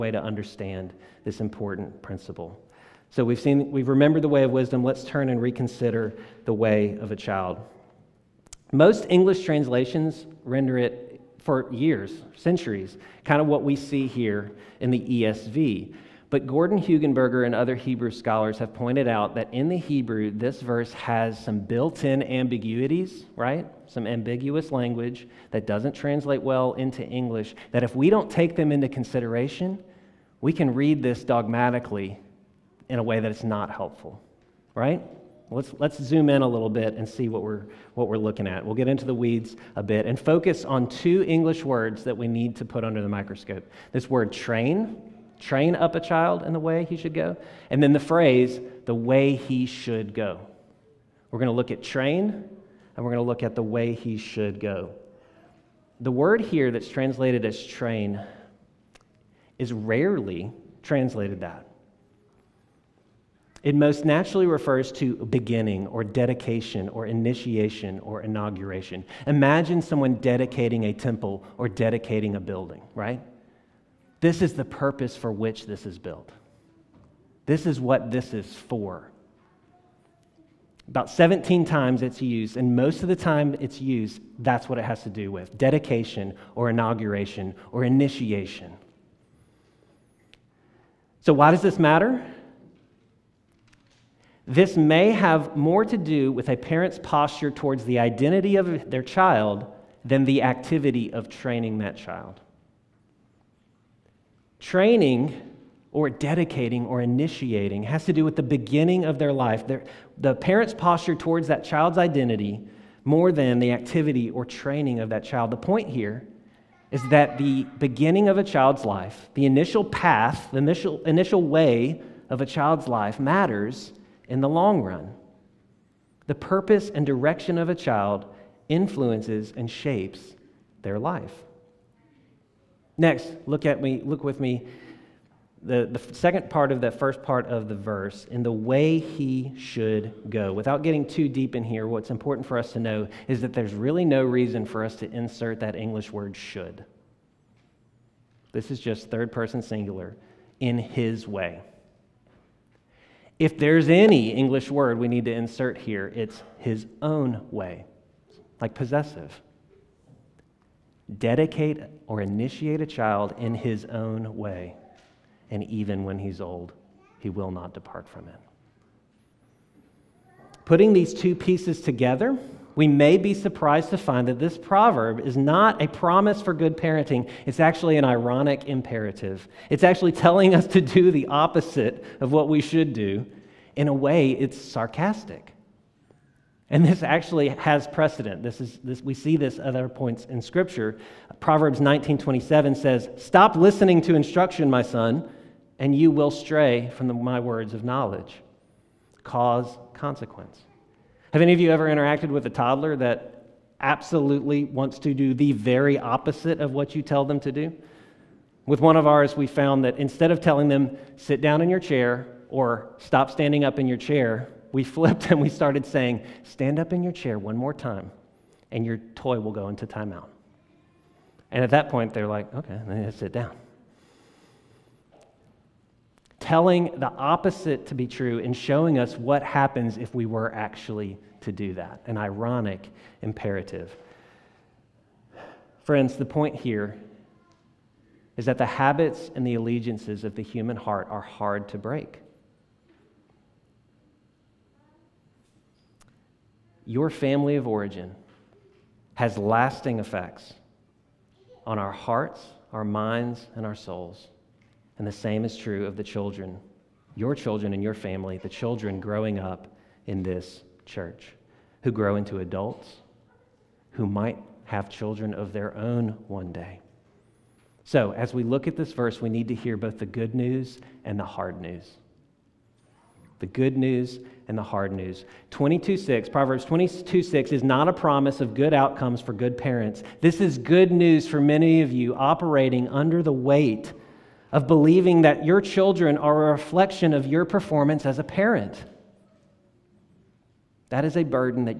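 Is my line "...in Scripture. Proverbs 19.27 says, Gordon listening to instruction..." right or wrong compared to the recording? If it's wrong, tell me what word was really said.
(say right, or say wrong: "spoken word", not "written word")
wrong: "Stop", not "Gordon".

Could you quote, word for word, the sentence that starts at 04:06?
Your family of origin has lasting effects on our hearts, our minds, and our souls.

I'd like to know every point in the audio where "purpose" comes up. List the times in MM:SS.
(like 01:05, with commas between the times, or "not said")
01:14, 02:06.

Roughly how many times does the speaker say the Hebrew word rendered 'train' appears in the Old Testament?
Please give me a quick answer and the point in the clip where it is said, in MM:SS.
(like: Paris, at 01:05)
17, at 01:21.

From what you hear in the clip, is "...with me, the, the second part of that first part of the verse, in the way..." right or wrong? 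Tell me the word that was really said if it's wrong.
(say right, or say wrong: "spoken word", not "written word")
right.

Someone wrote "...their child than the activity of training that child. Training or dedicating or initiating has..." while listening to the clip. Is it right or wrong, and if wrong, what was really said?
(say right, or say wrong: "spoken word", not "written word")
right.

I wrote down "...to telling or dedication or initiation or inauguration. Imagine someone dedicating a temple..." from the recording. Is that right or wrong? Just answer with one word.
wrong.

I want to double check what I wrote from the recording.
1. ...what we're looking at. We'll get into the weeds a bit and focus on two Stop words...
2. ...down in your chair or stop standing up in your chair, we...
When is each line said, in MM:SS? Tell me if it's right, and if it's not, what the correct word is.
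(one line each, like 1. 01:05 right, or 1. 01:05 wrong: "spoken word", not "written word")
1. 00:37 wrong: "English", not "Stop"
2. 03:31 right.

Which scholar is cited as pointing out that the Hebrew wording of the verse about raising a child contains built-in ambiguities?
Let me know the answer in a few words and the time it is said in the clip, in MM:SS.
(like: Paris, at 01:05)
Gordon Hugenberger, at 00:16.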